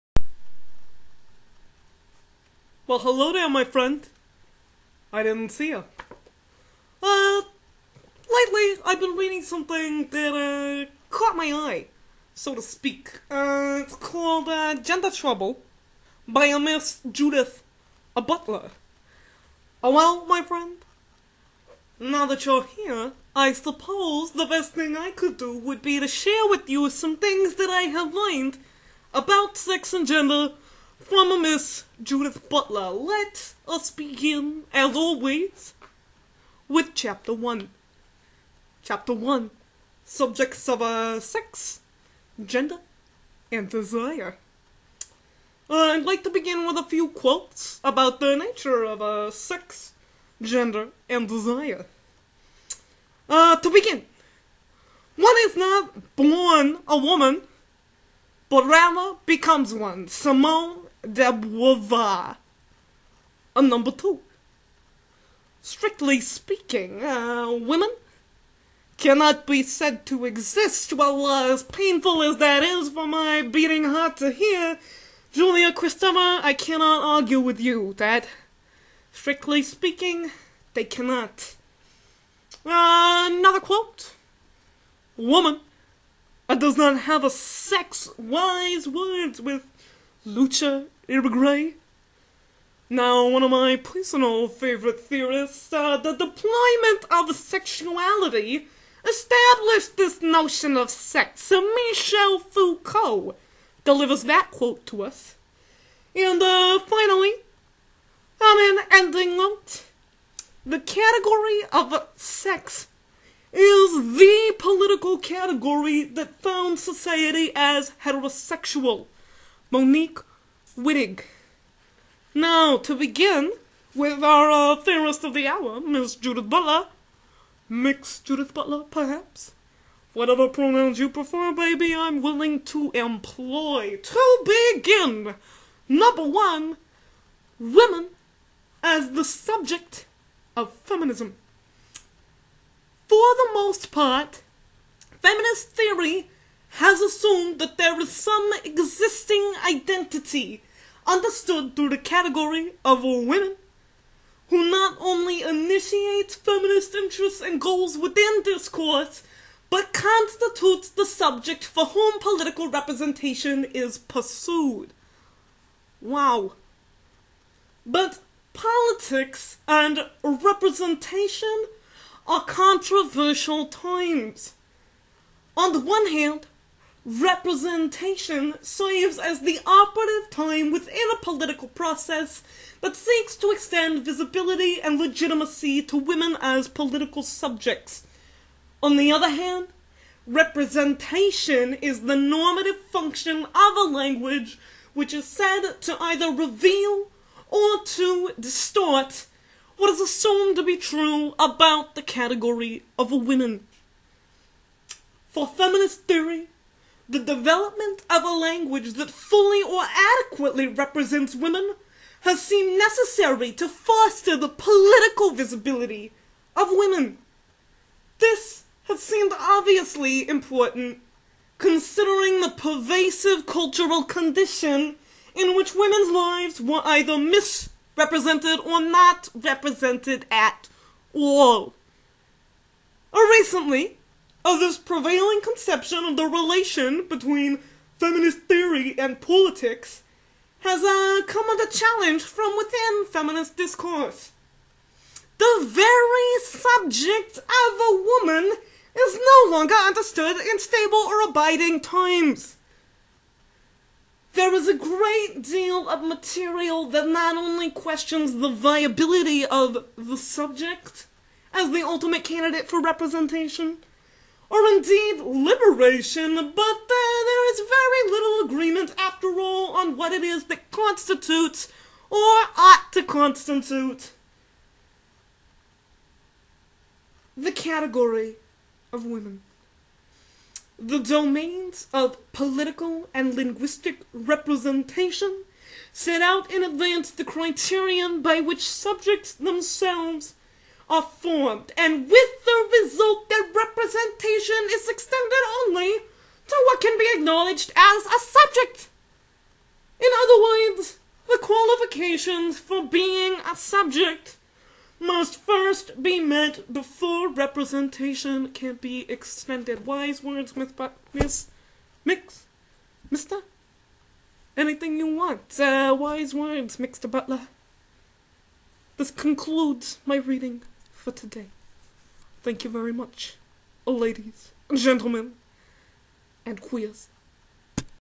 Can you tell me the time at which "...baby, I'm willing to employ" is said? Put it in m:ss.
2:11.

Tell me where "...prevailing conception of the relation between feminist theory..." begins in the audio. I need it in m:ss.
3:54.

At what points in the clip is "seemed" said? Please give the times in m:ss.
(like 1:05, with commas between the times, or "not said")
3:32, 3:39.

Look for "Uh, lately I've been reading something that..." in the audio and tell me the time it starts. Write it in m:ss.
0:07.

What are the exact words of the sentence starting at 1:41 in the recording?
Michel Foucault delivers that quote to us.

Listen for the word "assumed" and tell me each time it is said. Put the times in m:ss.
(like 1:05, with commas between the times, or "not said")
2:27, 3:20.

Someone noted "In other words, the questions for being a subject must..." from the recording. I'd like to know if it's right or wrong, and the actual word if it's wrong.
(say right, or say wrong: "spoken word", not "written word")
wrong: "qualifications", not "questions".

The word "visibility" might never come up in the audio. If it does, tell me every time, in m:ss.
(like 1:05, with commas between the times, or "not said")
3:04, 3:35.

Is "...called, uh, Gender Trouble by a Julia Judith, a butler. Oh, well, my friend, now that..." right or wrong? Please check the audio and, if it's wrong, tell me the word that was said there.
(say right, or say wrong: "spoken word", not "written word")
wrong: "Miss", not "Julia".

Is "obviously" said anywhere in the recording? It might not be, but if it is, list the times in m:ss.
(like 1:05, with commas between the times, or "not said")
3:39.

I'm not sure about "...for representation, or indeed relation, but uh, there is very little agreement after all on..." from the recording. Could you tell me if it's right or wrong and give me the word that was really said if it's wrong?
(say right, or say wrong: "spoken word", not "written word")
wrong: "liberation", not "relation".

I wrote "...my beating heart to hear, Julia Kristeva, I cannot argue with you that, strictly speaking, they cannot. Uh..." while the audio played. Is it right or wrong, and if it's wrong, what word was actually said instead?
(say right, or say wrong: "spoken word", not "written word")
right.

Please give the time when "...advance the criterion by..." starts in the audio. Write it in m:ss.
4:46.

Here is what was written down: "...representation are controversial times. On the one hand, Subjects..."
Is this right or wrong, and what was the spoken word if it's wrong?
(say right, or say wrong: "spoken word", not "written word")
wrong: "Representation", not "Subjects".